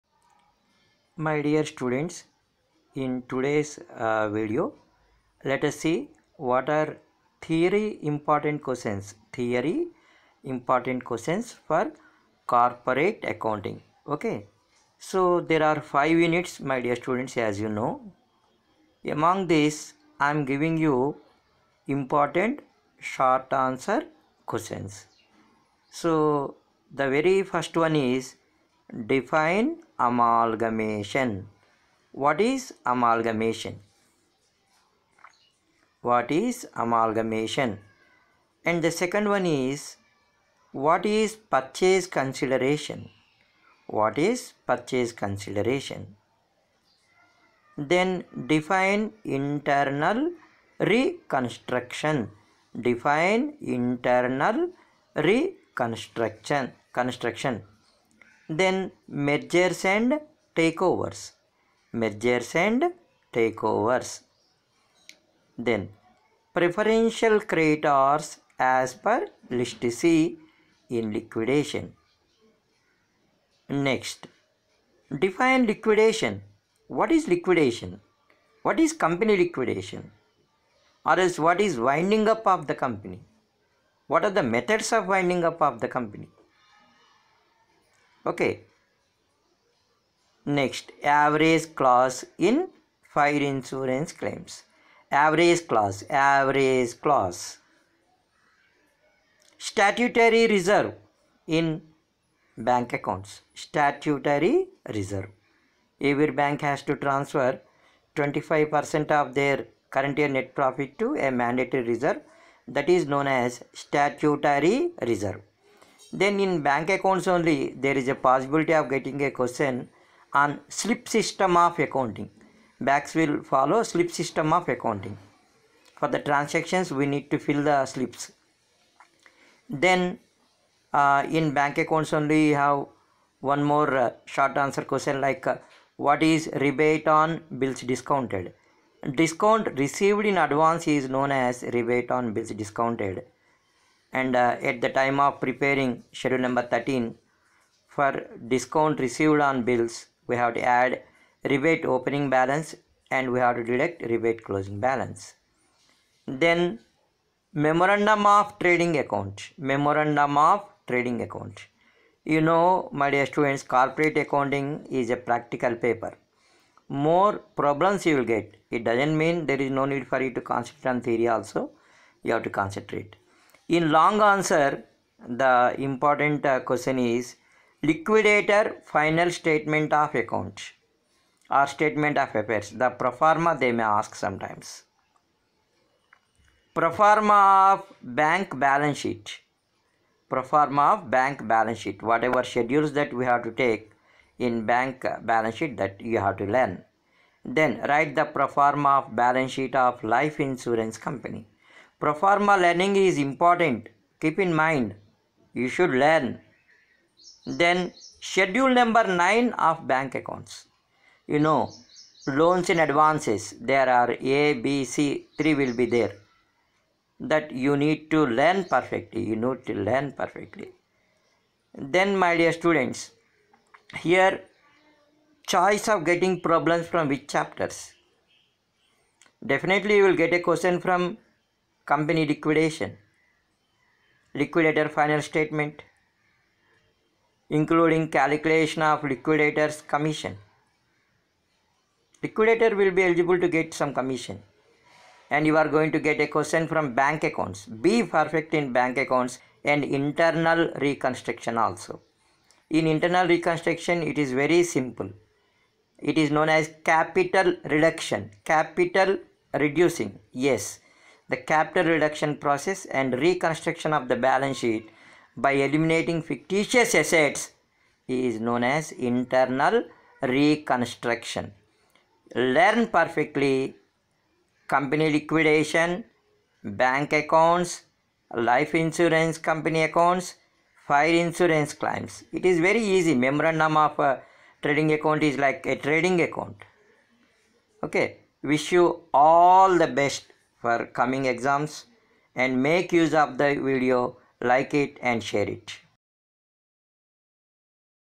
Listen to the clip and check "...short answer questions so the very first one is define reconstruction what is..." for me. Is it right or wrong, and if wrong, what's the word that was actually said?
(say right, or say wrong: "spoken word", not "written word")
wrong: "amalgamation", not "reconstruction".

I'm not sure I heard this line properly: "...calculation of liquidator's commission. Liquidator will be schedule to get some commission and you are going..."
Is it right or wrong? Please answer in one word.
wrong.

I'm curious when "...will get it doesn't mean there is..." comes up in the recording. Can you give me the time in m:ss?
2:48.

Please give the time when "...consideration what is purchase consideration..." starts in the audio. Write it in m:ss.
0:42.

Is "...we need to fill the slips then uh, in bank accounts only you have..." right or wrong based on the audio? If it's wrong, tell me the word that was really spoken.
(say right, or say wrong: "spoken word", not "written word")
right.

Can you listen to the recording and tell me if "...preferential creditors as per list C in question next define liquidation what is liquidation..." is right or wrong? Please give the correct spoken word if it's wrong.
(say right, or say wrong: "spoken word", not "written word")
wrong: "liquidation", not "question".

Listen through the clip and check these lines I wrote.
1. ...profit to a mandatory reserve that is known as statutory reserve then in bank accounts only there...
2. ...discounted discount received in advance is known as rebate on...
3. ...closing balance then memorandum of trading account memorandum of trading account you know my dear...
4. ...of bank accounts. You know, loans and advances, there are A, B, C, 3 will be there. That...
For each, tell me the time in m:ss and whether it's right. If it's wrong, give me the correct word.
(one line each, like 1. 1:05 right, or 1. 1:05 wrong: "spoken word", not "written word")
1. 1:50 right
2. 2:17 right
3. 2:34 right
4. 3:29 right.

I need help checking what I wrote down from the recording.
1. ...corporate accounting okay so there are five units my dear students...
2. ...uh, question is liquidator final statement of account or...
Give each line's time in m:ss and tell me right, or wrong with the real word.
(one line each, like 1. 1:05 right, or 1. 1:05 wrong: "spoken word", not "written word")
1. 0:12 right
2. 2:56 right.